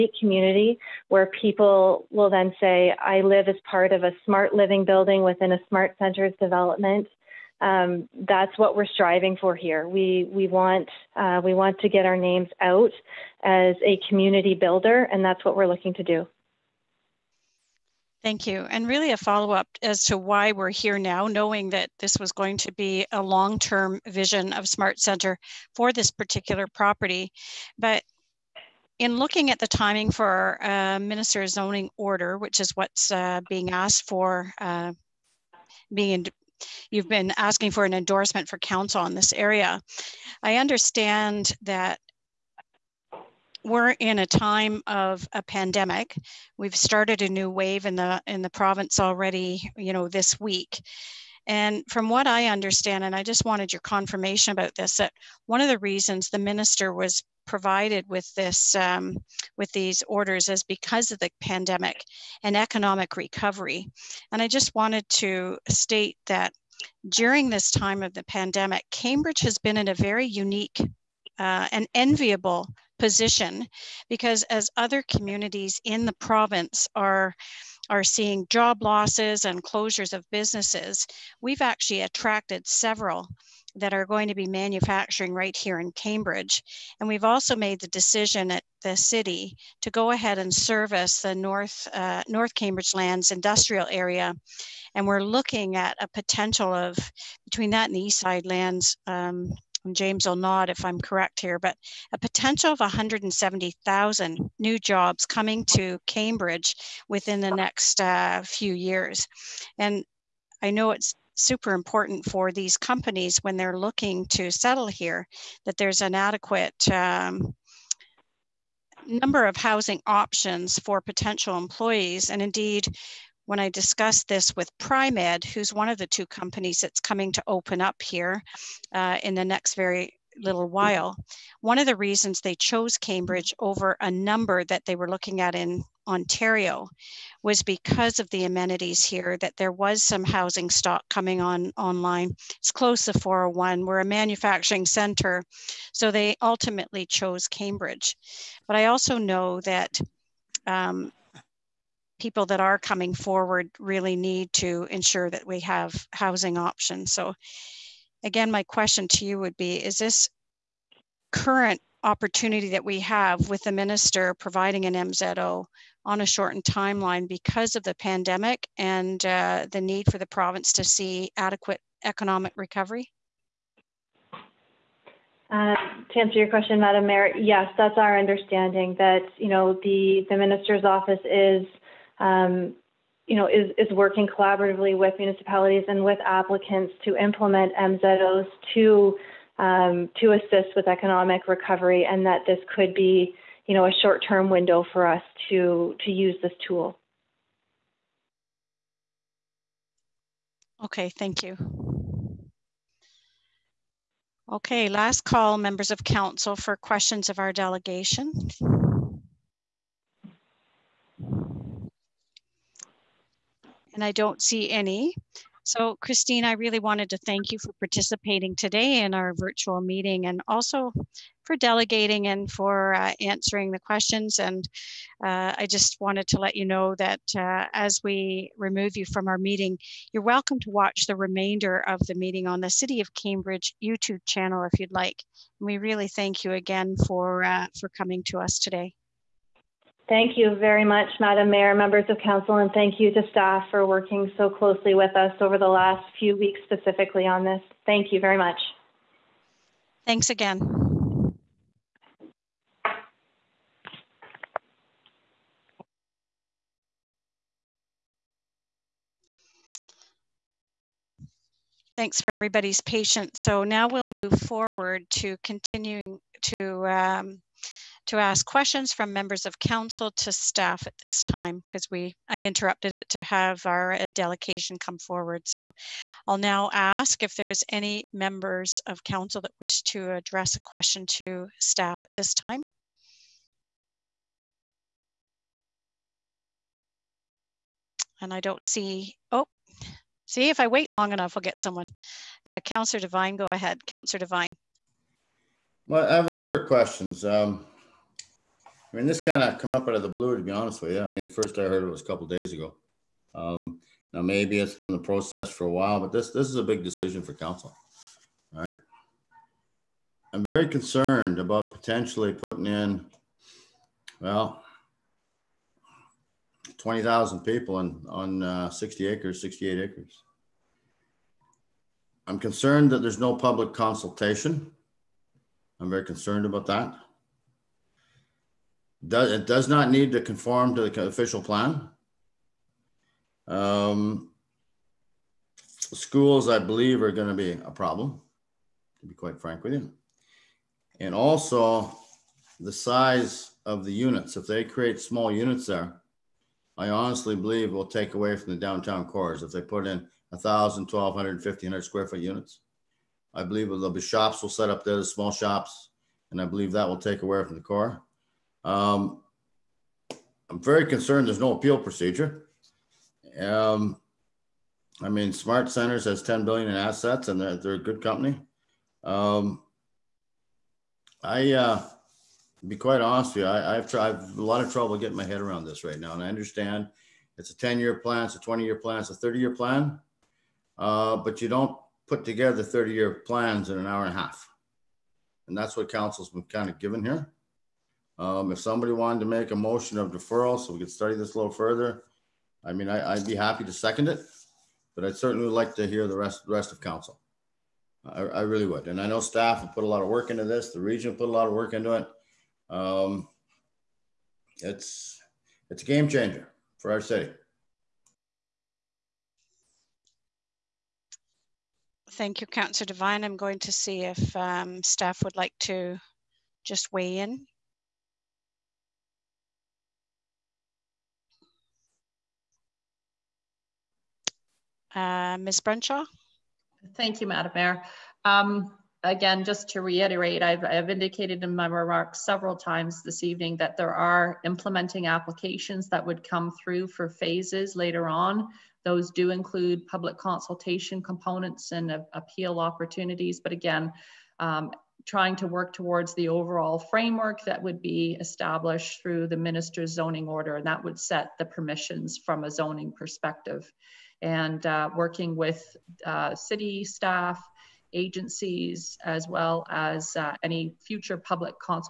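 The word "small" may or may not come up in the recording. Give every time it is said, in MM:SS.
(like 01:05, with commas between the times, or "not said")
05:45, 05:55.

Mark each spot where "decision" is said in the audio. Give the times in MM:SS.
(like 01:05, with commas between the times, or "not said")
01:27, 05:06.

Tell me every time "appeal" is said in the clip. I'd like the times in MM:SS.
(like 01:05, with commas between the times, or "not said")
06:01, 07:22.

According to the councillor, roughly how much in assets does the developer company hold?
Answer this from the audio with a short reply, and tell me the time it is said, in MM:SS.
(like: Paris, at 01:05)
10 billion, at 06:06.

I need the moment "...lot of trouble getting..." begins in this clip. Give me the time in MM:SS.
06:14.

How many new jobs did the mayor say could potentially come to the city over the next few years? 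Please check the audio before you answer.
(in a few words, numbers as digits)
170,000.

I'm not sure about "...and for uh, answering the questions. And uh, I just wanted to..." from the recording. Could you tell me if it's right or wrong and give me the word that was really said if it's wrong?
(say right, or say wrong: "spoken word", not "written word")
right.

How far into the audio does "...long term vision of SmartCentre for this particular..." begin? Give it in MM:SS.
00:23.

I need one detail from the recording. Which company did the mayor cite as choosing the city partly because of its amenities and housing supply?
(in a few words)
Primed.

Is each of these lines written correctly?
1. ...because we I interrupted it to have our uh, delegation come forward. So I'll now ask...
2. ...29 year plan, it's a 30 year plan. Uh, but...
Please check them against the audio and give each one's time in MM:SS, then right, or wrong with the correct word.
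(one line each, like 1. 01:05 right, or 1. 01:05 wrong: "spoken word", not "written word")
1. 04:31 right
2. 06:18 wrong: "20", not "29".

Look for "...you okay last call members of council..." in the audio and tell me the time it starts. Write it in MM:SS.
03:21.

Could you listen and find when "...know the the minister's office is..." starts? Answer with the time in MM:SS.
02:59.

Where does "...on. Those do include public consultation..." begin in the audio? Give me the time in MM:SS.
07:18.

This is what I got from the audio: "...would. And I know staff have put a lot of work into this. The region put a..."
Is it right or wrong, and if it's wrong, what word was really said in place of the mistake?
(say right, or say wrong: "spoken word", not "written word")
right.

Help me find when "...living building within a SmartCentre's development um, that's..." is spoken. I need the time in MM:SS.
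00:04.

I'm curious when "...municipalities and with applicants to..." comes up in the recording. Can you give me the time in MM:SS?
03:05.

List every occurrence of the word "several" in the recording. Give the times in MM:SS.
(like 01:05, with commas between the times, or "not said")
01:22, 07:12.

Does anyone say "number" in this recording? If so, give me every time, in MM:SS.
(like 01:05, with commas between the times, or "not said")
01:59, 02:14, 04:56.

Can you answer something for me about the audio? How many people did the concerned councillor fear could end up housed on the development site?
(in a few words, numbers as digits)
20,000.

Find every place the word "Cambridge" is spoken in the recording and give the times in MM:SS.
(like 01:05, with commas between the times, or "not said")
01:08, 01:25, 01:32, 01:46, 02:12, 02:27, 03:53.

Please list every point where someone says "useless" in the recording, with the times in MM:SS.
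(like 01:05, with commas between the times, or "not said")
not said.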